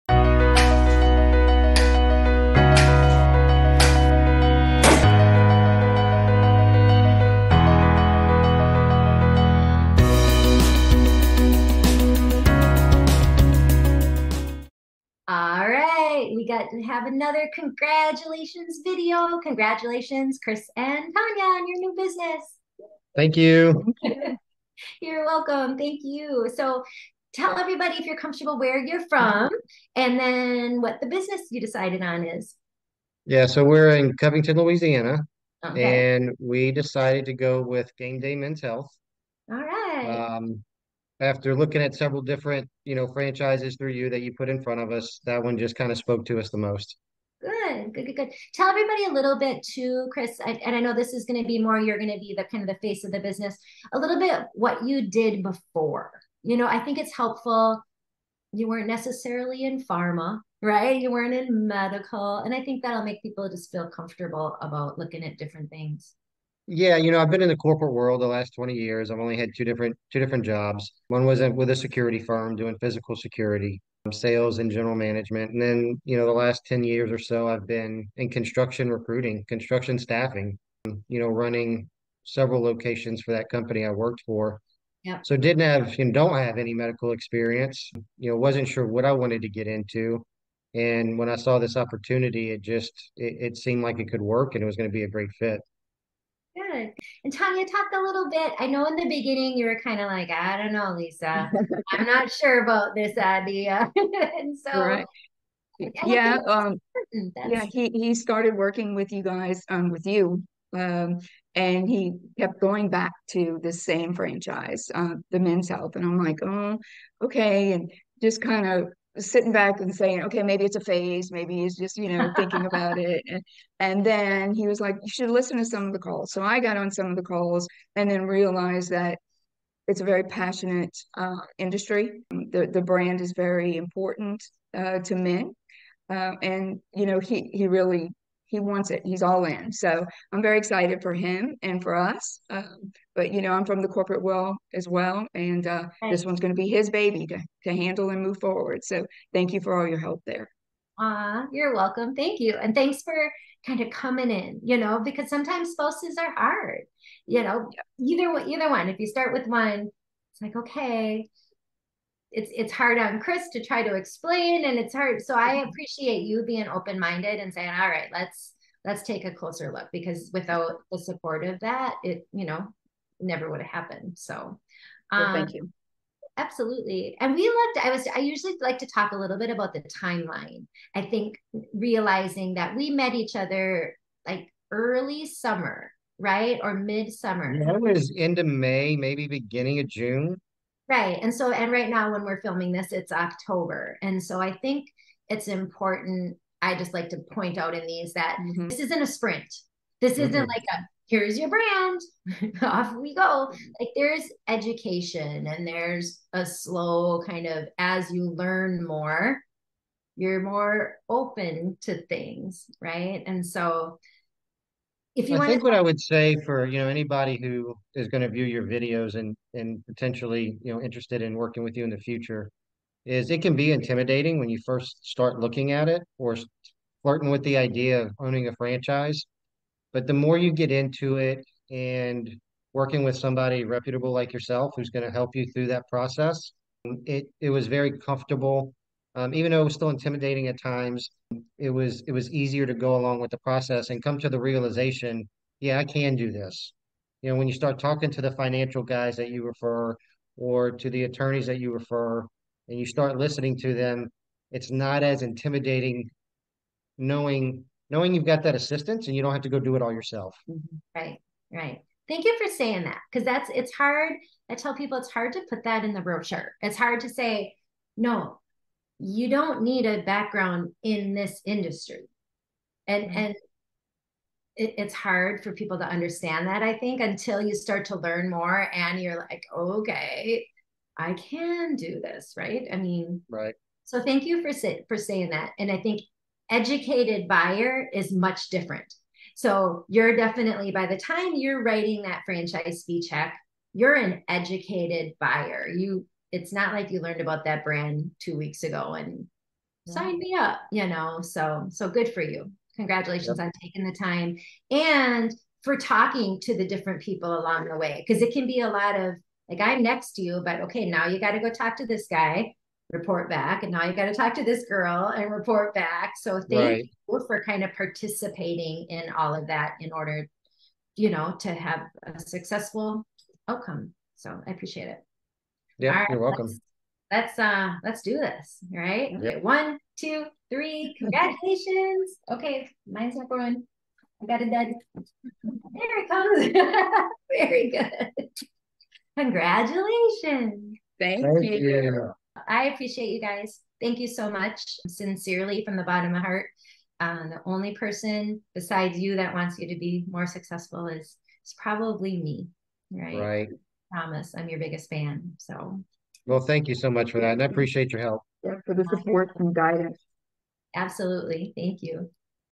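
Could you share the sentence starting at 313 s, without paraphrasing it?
And now you got to talk to this girl and report back.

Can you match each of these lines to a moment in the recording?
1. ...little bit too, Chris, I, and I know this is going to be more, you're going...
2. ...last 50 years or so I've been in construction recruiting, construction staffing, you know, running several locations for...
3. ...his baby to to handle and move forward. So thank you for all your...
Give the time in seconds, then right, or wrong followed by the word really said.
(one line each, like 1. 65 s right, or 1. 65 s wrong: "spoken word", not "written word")
1. 49 s right
2. 76 s wrong: "10", not "50"
3. 146 s right.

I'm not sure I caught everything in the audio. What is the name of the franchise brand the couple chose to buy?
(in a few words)
Game Day Men's Health.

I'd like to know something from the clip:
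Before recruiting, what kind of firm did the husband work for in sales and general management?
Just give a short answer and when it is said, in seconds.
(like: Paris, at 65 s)
security firm, at 71 s.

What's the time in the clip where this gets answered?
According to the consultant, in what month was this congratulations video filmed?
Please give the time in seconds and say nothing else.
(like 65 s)
193 s.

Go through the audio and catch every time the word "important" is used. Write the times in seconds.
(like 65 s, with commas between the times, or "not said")
133 s, 195 s.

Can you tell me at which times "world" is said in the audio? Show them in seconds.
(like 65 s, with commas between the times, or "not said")
67 s, 144 s.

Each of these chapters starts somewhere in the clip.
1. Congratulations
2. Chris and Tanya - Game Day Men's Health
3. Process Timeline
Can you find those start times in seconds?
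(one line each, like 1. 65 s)
1. 326 s
2. 26 s
3. 175 s.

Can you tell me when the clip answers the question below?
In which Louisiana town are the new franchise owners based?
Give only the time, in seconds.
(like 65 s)
34 s.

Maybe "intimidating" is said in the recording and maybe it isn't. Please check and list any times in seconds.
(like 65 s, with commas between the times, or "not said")
223 s, 239 s, 255 s.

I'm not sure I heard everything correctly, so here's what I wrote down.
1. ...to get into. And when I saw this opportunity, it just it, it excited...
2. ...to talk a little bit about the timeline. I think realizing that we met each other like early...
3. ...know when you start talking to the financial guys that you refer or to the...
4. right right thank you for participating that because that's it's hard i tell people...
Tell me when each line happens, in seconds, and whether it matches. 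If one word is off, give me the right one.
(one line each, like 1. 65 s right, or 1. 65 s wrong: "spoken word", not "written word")
1. 89 s wrong: "seemed", not "excited"
2. 178 s right
3. 247 s right
4. 260 s wrong: "saying", not "participating".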